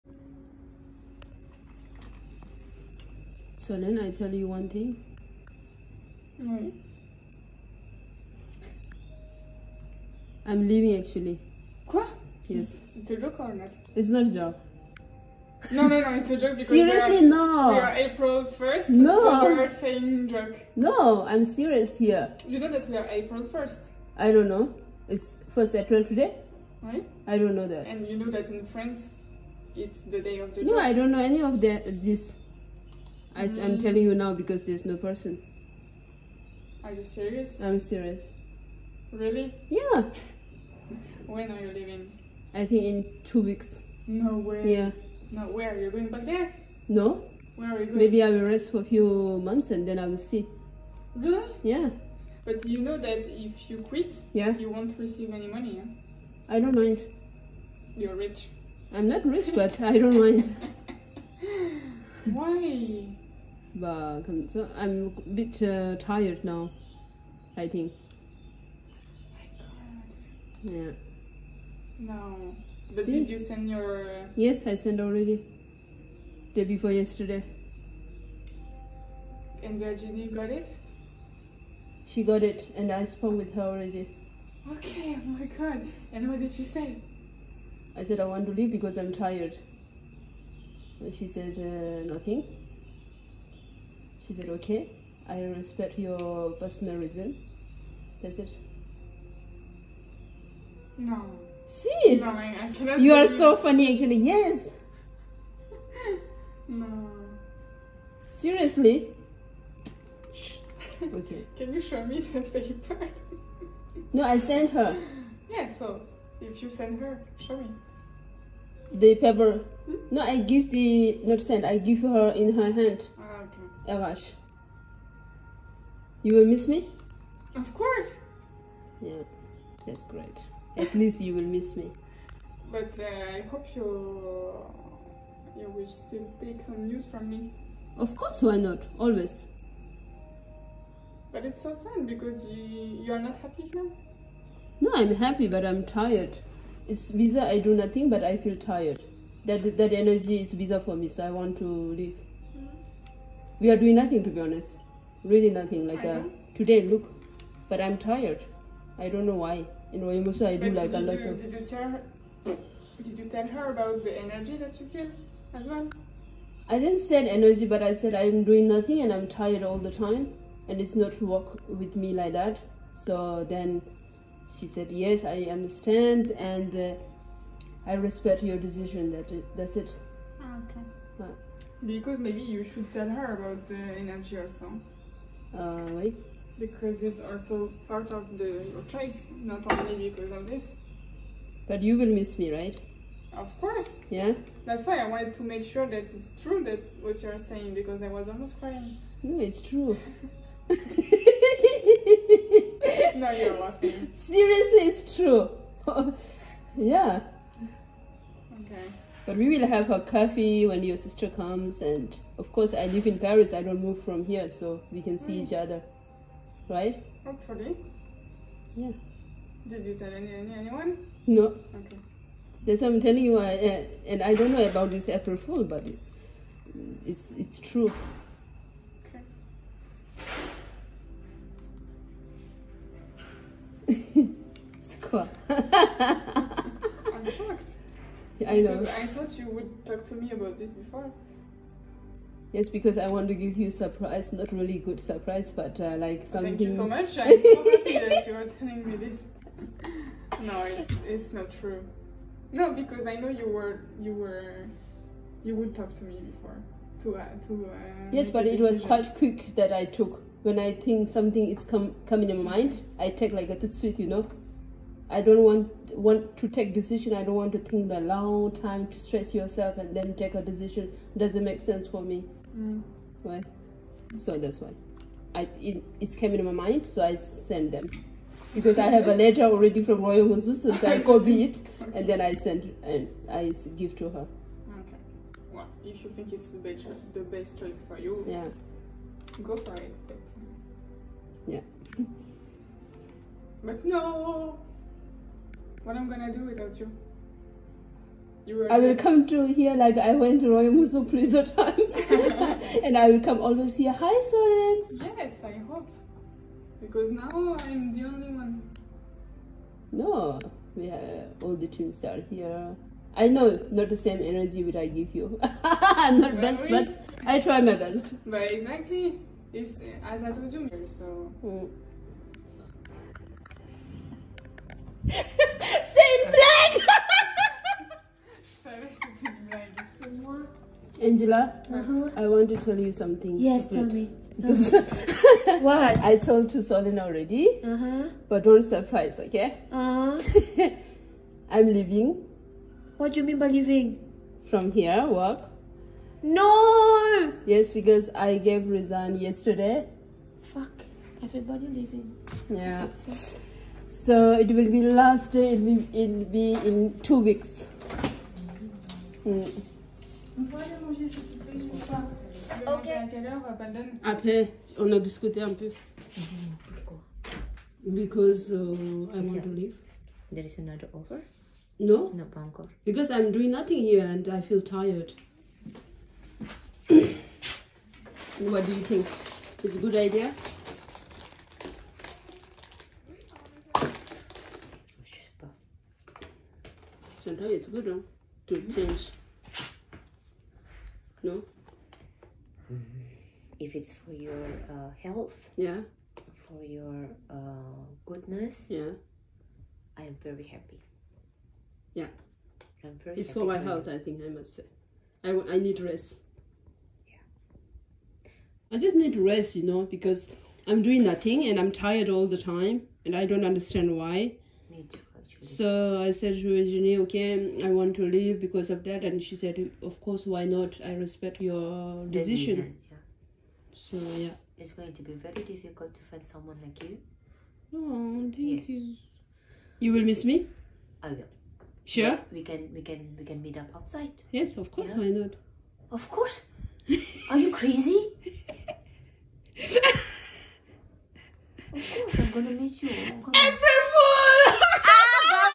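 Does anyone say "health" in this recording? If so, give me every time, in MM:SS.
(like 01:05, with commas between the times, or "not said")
06:35, 06:43.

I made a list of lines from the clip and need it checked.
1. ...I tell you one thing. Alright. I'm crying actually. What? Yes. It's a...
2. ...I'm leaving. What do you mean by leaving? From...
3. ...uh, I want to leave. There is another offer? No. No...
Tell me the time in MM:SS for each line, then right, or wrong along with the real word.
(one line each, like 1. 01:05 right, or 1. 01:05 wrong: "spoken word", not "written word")
1. 00:03 wrong: "leaving", not "crying"
2. 05:41 right
3. 06:08 right.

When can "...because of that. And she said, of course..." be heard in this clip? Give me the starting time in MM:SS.
06:58.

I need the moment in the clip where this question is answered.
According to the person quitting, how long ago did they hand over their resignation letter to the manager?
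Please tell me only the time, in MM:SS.
01:16.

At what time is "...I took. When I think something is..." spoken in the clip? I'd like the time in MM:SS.
04:19.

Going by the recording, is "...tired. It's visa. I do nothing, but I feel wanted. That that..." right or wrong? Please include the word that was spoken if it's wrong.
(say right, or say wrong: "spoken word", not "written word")
wrong: "tired", not "wanted".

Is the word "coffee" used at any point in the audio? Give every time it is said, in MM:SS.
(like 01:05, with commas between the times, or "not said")
03:29.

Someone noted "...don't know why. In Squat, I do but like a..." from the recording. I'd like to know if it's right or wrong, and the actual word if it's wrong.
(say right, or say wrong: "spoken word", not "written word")
wrong: "Royamusu", not "Squat".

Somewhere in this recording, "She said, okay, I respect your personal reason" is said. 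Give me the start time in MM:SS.
01:34.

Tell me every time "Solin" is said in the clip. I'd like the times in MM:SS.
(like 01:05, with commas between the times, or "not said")
05:36.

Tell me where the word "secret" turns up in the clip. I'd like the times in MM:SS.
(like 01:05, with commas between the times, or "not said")
05:33.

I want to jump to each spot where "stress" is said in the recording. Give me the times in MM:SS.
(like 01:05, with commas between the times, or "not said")
04:28.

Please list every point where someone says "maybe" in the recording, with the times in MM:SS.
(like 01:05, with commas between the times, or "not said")
00:47, 03:02.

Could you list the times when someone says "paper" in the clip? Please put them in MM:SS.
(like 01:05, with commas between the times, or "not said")
01:52, 01:59.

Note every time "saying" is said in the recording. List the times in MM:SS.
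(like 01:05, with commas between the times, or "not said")
00:19, 03:17.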